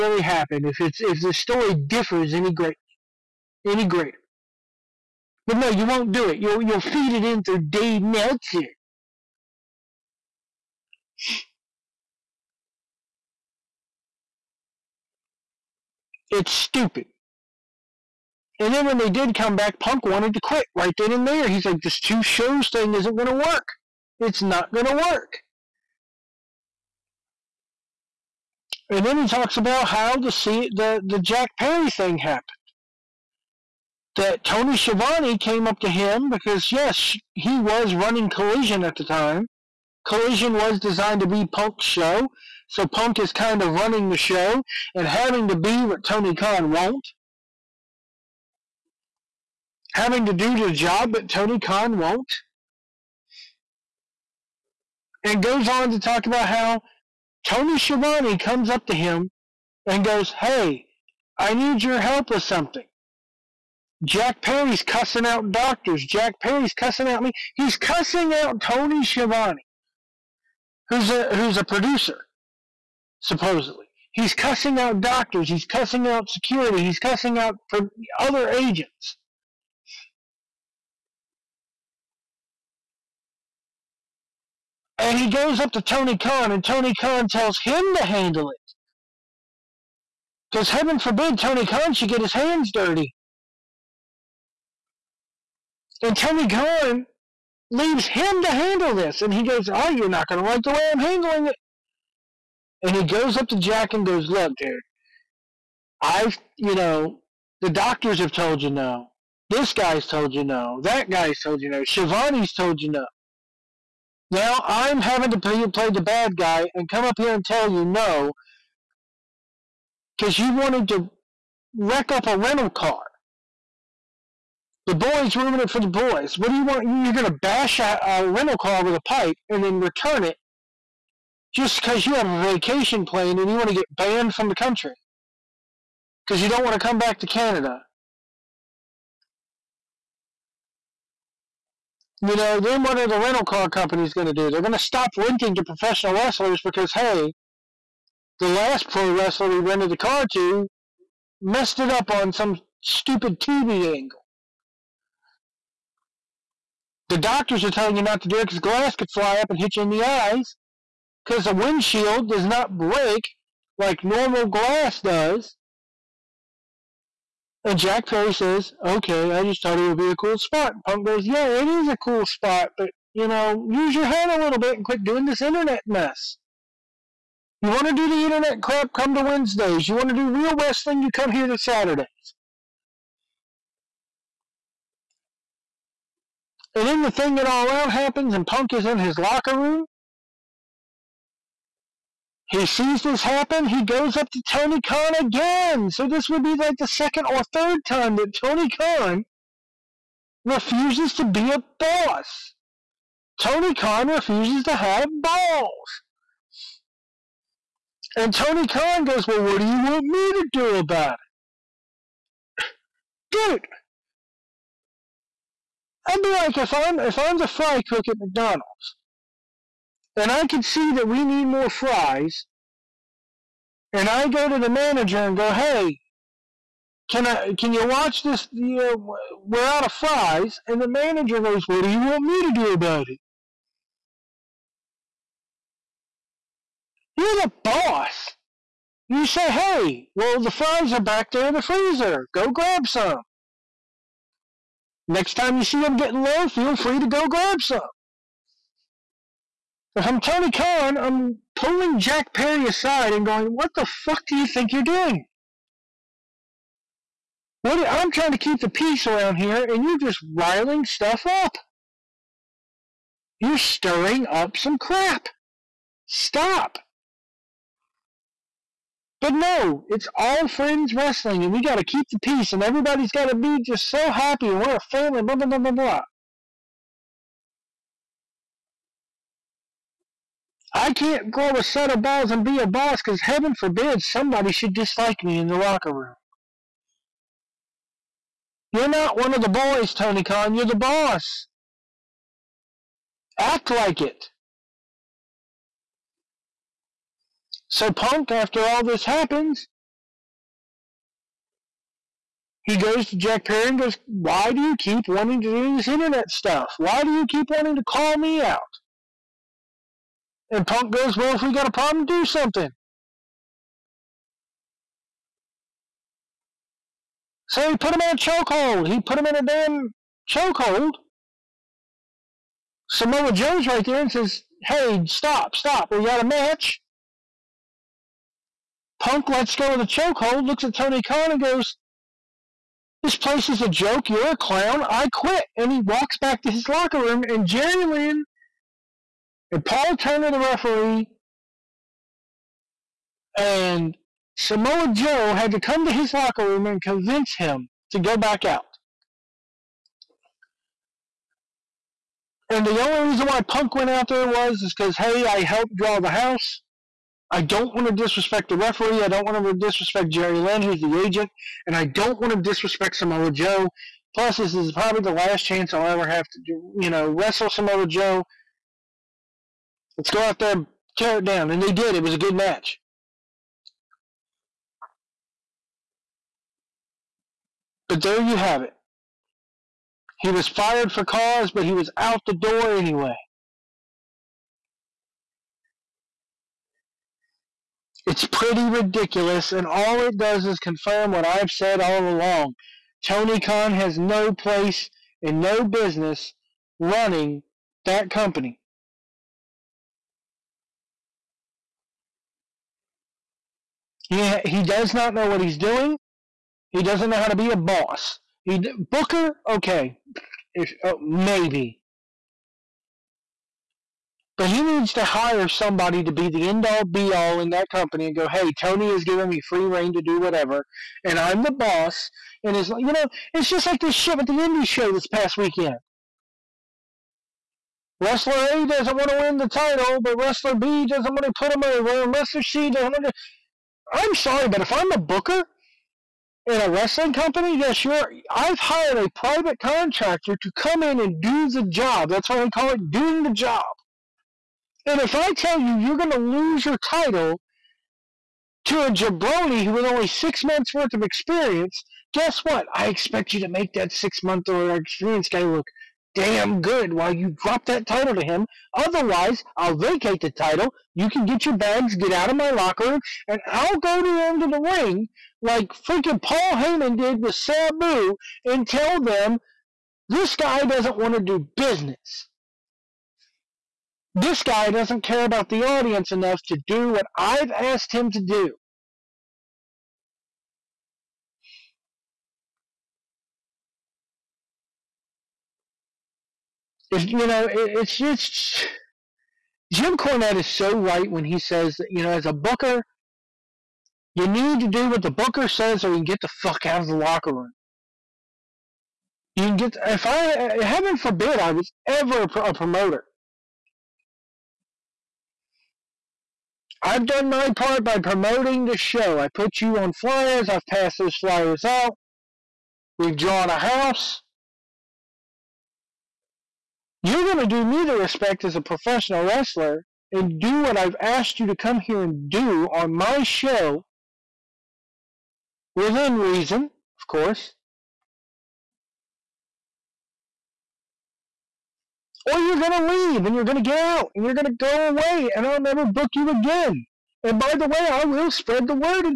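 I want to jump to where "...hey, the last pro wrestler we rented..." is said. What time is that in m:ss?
2:26.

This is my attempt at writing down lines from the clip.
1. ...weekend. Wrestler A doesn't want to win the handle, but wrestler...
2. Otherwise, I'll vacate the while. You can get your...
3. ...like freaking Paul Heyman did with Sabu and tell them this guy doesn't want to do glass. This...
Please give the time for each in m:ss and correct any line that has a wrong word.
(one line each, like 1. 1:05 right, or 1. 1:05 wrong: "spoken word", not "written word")
1. 7:05 wrong: "title", not "handle"
2. 7:38 wrong: "title", not "while"
3. 7:45 wrong: "business", not "glass".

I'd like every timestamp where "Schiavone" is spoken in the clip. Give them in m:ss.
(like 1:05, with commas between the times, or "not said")
0:34, 0:57, 1:09, 1:51.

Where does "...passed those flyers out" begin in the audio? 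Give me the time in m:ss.
8:30.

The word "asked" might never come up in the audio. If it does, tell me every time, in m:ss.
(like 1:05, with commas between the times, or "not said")
7:57, 8:41.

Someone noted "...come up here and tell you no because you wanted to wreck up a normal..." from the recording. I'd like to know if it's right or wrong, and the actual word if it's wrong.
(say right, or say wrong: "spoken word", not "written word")
wrong: "rental", not "normal".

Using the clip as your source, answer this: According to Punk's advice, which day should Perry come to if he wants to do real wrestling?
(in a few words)
Saturday.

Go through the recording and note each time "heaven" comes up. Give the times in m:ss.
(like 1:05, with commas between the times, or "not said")
1:30, 4:43, 8:20.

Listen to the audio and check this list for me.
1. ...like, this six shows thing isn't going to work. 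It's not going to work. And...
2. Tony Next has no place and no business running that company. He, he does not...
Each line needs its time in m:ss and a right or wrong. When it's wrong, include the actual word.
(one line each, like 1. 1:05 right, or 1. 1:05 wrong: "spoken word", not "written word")
1. 0:21 wrong: "two", not "six"
2. 6:33 wrong: "Khan", not "Next".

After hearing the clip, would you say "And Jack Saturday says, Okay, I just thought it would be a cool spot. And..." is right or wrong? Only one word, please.
wrong.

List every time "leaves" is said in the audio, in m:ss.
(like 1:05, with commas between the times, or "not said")
1:37, 8:52.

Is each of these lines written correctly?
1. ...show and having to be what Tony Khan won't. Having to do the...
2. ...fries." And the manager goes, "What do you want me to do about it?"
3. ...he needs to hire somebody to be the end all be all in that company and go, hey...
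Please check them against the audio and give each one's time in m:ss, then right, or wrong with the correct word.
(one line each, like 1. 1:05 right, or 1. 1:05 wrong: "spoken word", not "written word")
1. 0:44 right
2. 3:49 right
3. 6:54 right.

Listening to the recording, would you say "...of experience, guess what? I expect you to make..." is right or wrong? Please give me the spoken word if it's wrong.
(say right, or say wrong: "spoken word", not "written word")
right.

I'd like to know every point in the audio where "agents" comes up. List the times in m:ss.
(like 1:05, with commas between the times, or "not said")
1:18, 6:00.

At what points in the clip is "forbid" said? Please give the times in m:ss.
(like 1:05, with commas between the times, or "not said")
1:31, 4:43, 8:20.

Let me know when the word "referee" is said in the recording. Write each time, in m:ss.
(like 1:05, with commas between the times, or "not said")
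5:40, 5:58.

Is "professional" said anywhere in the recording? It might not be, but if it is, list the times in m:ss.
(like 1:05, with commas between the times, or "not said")
2:25, 8:38.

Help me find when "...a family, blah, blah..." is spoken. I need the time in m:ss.
4:34.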